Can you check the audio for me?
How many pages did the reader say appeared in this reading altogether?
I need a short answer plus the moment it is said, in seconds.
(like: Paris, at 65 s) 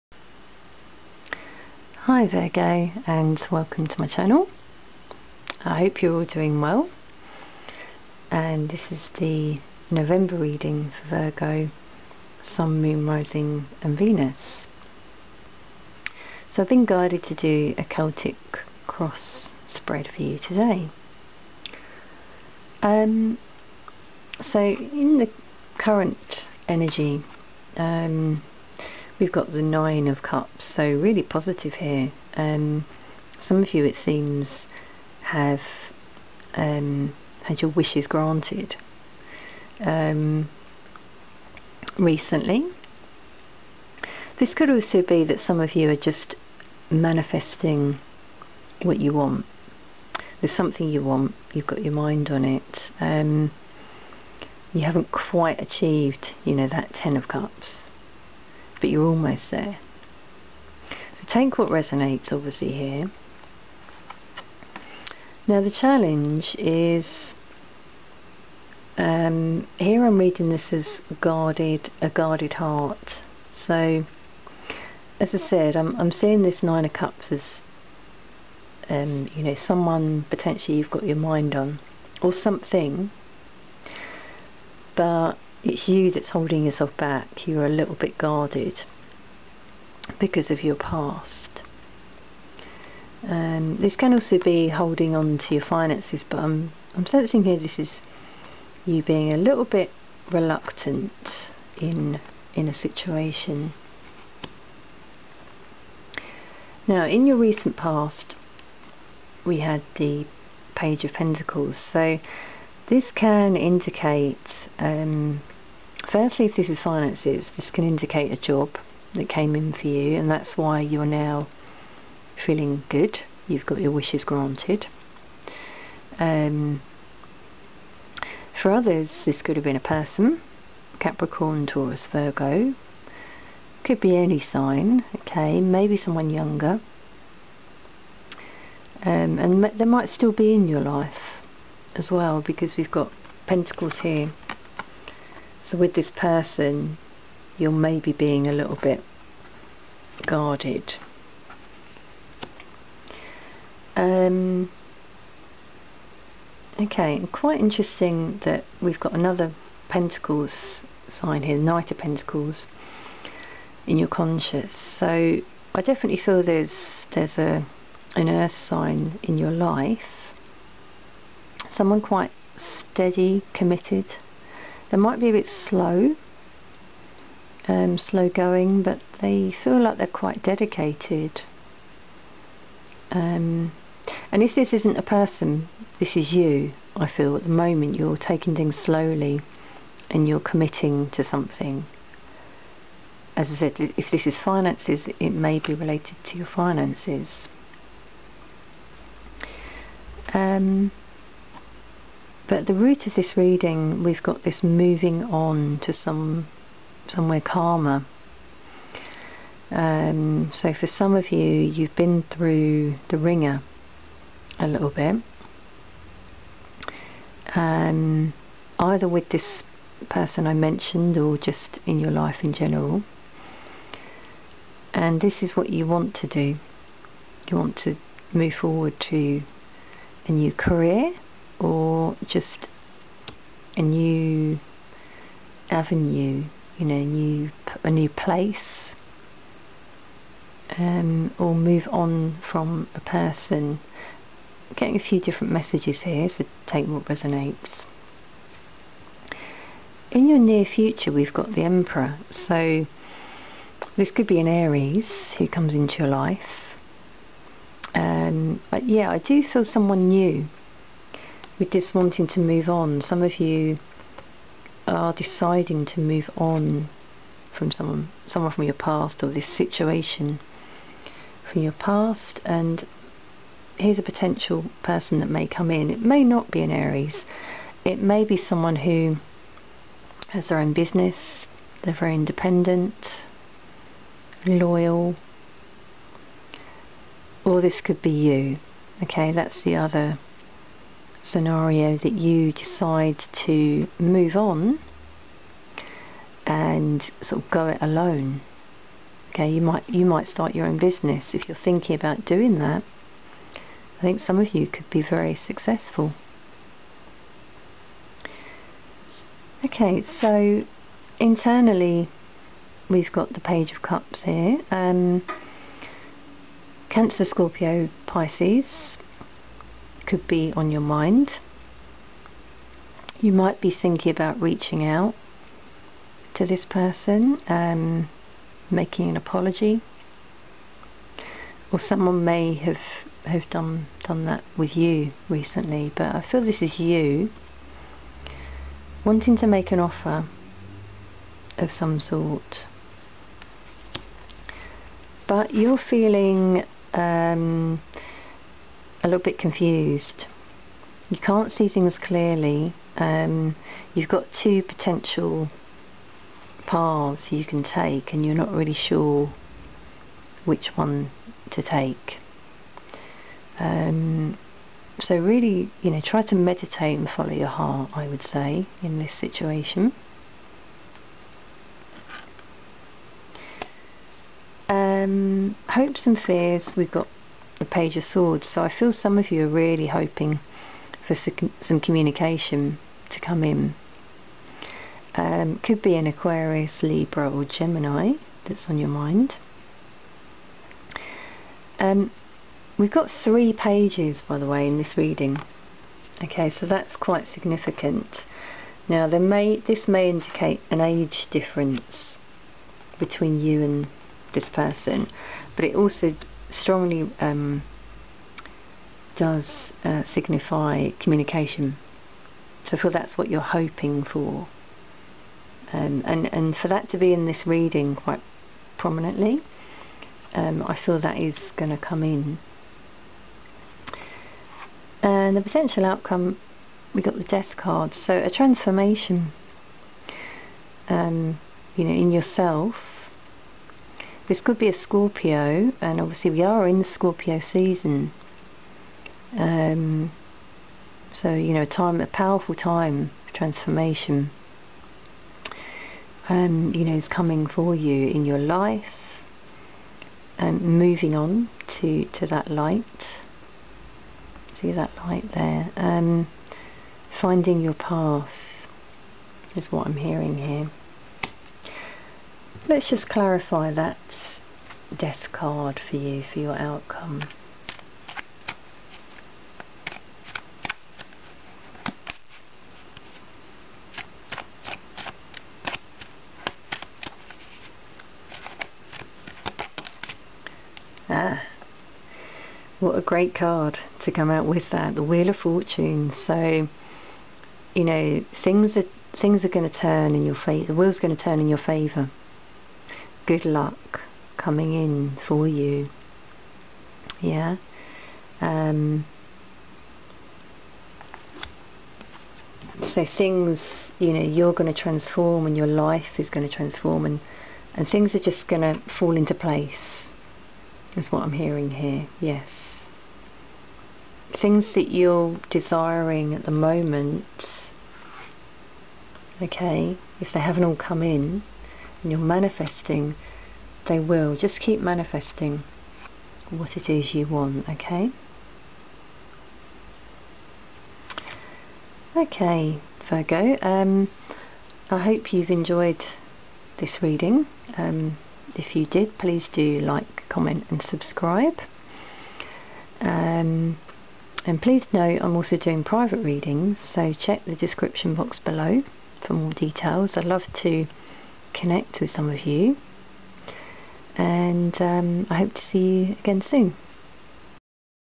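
3, at 393 s.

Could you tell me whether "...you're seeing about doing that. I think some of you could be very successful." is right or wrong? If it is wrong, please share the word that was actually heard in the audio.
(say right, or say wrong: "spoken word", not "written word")
wrong: "thinking", not "seeing".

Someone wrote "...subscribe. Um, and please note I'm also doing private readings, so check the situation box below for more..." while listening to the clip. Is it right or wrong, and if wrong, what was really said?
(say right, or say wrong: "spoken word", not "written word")
wrong: "description", not "situation".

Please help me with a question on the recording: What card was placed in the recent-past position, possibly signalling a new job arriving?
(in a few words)
Page of Pentacles.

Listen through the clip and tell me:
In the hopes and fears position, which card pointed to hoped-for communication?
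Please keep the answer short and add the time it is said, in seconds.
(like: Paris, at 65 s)
Page of Swords, at 377 s.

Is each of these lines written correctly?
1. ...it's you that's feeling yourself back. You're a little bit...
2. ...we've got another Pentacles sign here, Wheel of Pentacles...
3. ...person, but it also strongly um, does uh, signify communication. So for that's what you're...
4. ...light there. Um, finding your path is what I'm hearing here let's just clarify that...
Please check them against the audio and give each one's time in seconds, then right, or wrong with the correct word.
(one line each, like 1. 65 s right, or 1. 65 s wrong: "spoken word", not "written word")
1. 85 s wrong: "holding", not "feeling"
2. 158 s wrong: "Knight", not "Wheel"
3. 404 s right
4. 455 s right.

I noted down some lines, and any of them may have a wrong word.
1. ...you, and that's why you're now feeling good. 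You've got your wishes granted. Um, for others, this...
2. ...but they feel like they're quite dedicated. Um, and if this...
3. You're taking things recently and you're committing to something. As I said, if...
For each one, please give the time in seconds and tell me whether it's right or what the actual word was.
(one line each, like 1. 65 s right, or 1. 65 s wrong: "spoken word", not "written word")
1. 119 s right
2. 178 s right
3. 187 s wrong: "slowly", not "recently".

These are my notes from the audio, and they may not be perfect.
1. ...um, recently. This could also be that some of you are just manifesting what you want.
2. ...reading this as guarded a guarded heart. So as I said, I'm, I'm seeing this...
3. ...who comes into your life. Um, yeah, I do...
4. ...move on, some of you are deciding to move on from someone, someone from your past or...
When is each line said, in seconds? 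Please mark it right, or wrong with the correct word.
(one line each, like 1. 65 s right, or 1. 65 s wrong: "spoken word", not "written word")
1. 39 s right
2. 70 s right
3. 255 s right
4. 262 s right.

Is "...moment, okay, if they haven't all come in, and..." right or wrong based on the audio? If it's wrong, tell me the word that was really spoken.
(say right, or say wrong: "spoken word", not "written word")
right.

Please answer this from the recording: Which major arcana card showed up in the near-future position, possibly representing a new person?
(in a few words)
The Emperor.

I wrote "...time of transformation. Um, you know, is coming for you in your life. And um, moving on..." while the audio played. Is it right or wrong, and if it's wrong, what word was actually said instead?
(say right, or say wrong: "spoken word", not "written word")
right.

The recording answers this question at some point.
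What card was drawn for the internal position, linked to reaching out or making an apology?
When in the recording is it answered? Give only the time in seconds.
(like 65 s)
313 s.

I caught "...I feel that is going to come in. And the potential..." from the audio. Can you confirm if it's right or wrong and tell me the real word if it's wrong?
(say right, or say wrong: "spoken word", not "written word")
right.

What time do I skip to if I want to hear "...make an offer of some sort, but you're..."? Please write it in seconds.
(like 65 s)
339 s.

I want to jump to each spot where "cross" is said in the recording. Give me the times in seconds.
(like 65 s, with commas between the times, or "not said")
18 s.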